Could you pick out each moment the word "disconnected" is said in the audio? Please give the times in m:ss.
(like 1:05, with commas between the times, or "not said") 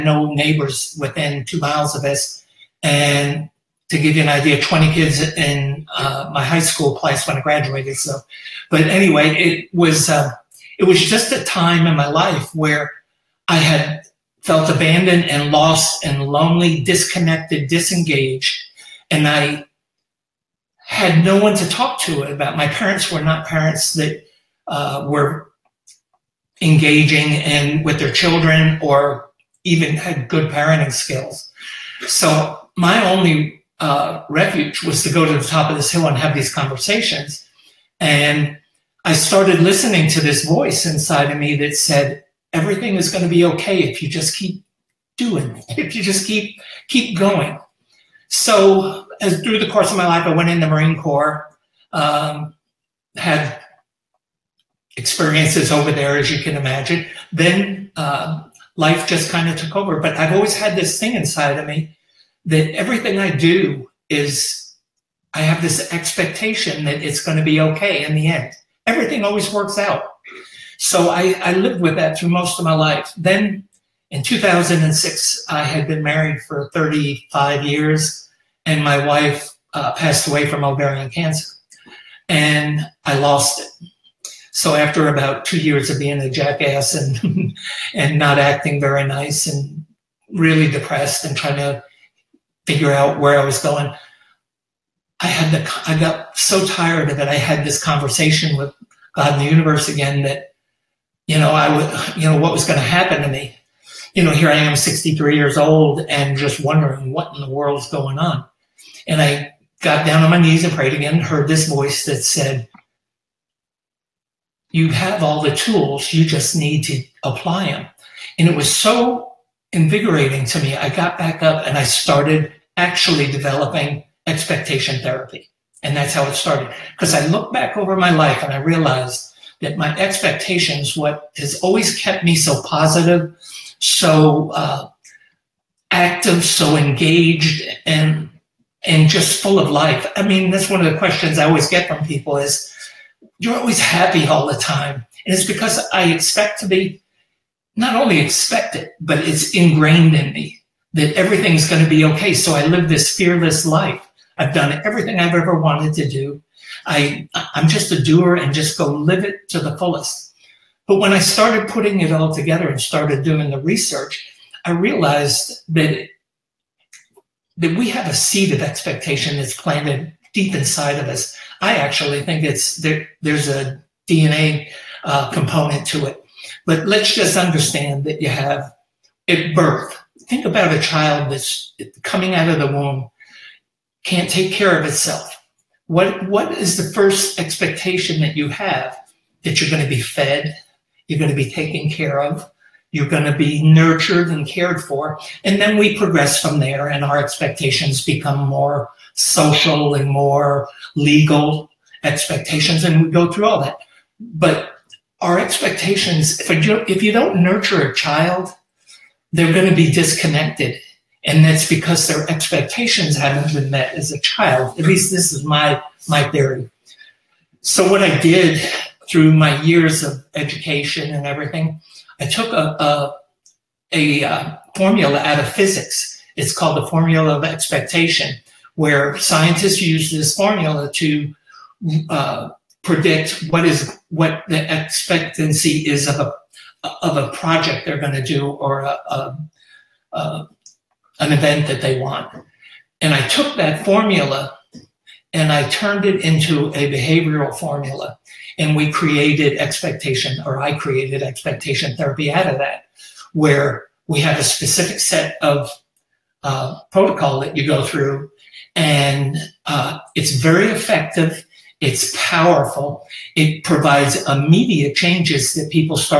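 0:16, 3:29.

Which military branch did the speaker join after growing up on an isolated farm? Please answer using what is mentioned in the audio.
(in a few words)
Marine Corps.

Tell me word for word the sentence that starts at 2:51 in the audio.
I actually think it's there, there's a DNA uh, component to it.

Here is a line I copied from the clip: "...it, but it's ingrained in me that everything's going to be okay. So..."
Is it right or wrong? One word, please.
right.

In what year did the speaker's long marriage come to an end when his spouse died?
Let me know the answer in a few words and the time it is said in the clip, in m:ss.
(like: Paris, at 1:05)
2006, at 1:14.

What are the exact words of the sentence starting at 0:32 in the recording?
So my only uh, refuge was to go to the top of this hill and have these conversations.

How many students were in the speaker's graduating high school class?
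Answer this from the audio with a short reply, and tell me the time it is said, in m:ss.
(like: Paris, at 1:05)
20, at 0:04.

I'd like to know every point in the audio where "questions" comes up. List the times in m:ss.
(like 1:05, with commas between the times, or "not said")
2:20.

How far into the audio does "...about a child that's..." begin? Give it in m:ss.
3:00.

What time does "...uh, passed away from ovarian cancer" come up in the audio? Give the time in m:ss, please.
1:19.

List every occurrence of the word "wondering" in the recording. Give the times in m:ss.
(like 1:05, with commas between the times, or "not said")
1:46.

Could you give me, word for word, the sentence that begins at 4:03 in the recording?
And I took that formula and I turned it into a behavioral formula.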